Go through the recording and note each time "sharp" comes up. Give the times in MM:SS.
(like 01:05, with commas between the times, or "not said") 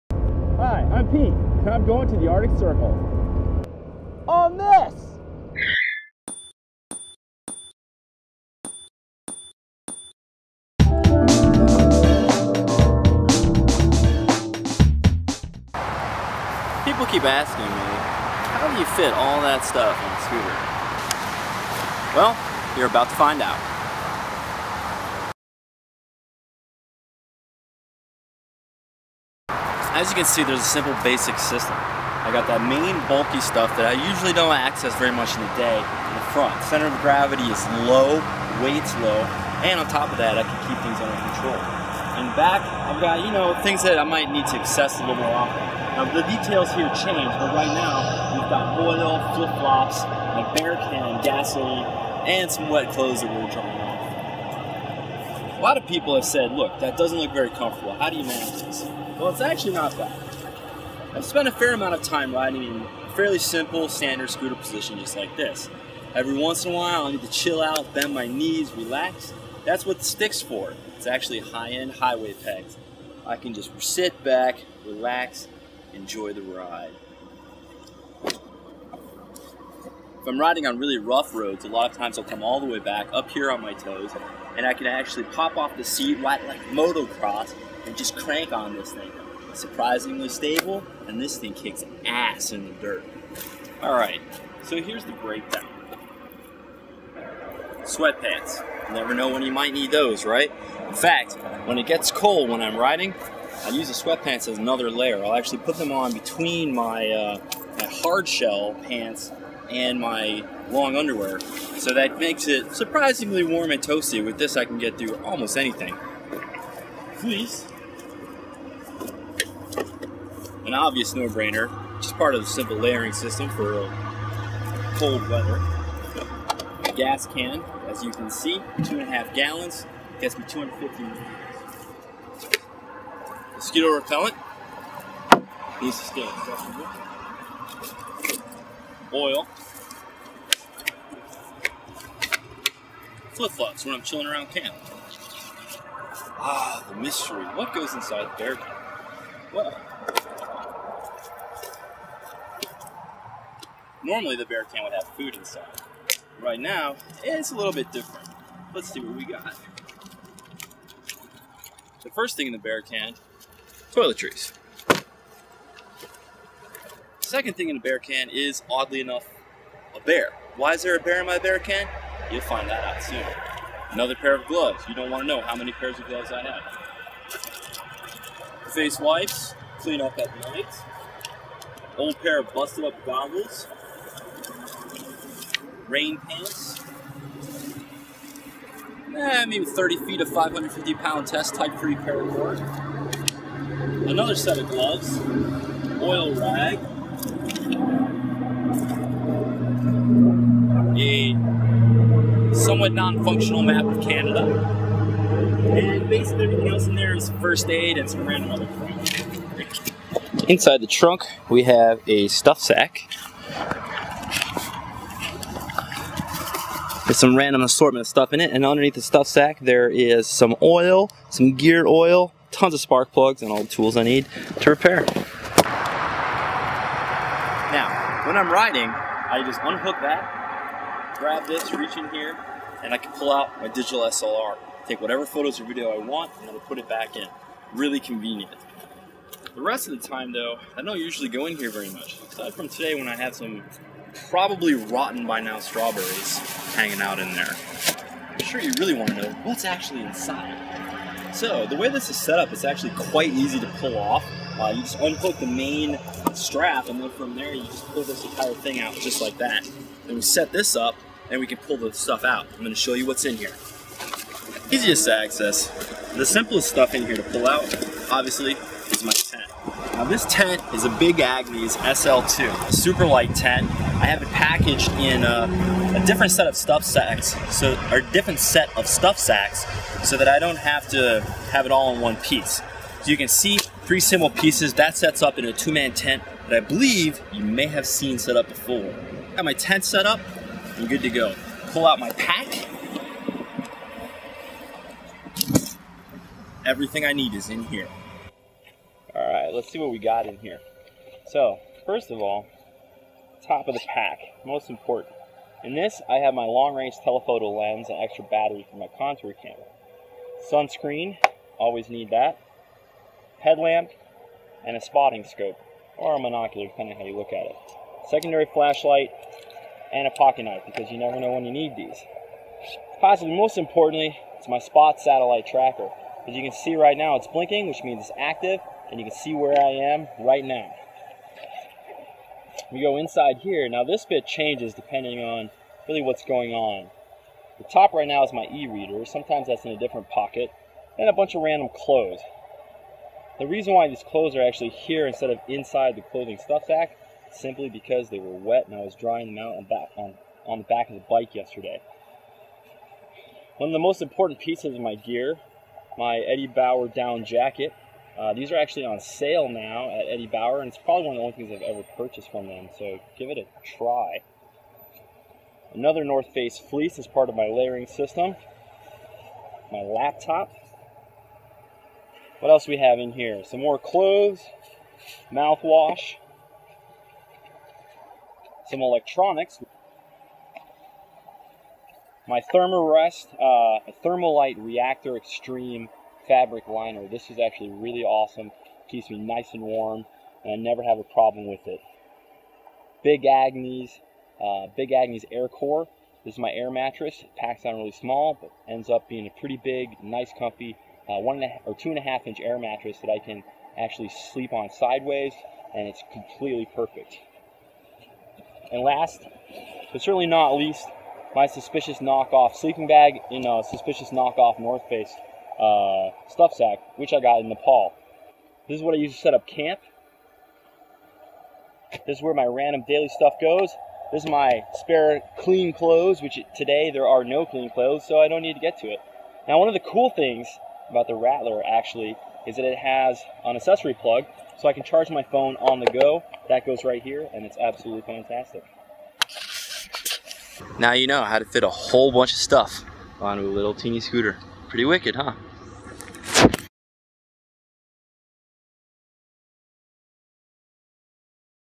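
not said.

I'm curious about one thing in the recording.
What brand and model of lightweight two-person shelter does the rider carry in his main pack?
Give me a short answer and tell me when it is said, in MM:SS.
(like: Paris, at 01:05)
Big Agnes SL2, at 04:30.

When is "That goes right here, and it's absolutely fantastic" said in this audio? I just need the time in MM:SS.
07:16.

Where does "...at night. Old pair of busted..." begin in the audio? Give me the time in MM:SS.
03:00.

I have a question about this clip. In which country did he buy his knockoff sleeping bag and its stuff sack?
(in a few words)
Nepal.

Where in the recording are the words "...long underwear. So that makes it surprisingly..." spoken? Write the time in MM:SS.
01:50.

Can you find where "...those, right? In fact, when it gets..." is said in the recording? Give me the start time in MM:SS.
01:39.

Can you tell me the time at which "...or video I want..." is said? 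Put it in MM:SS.
03:55.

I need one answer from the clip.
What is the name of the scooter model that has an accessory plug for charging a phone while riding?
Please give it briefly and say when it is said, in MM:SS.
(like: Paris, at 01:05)
Rattler, at 07:11.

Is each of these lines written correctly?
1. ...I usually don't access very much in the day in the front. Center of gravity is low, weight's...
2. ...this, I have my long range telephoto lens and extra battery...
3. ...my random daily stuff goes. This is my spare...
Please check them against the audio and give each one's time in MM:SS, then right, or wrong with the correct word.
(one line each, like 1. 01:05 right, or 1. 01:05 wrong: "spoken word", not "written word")
1. 00:33 right
2. 05:05 right
3. 07:02 right.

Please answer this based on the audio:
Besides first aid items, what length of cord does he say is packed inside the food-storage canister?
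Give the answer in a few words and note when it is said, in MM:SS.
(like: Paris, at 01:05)
30 feet, at 03:09.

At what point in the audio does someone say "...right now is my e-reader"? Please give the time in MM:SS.
05:37.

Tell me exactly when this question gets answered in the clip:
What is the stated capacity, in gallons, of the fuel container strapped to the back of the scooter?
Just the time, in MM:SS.
02:08.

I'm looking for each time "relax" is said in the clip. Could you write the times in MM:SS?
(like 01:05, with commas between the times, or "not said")
01:08, 01:14.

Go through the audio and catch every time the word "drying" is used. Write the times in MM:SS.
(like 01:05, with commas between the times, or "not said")
00:53, 05:48.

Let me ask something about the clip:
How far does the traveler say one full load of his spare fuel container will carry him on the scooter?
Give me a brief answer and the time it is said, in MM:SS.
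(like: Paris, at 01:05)
250 miles, at 02:10.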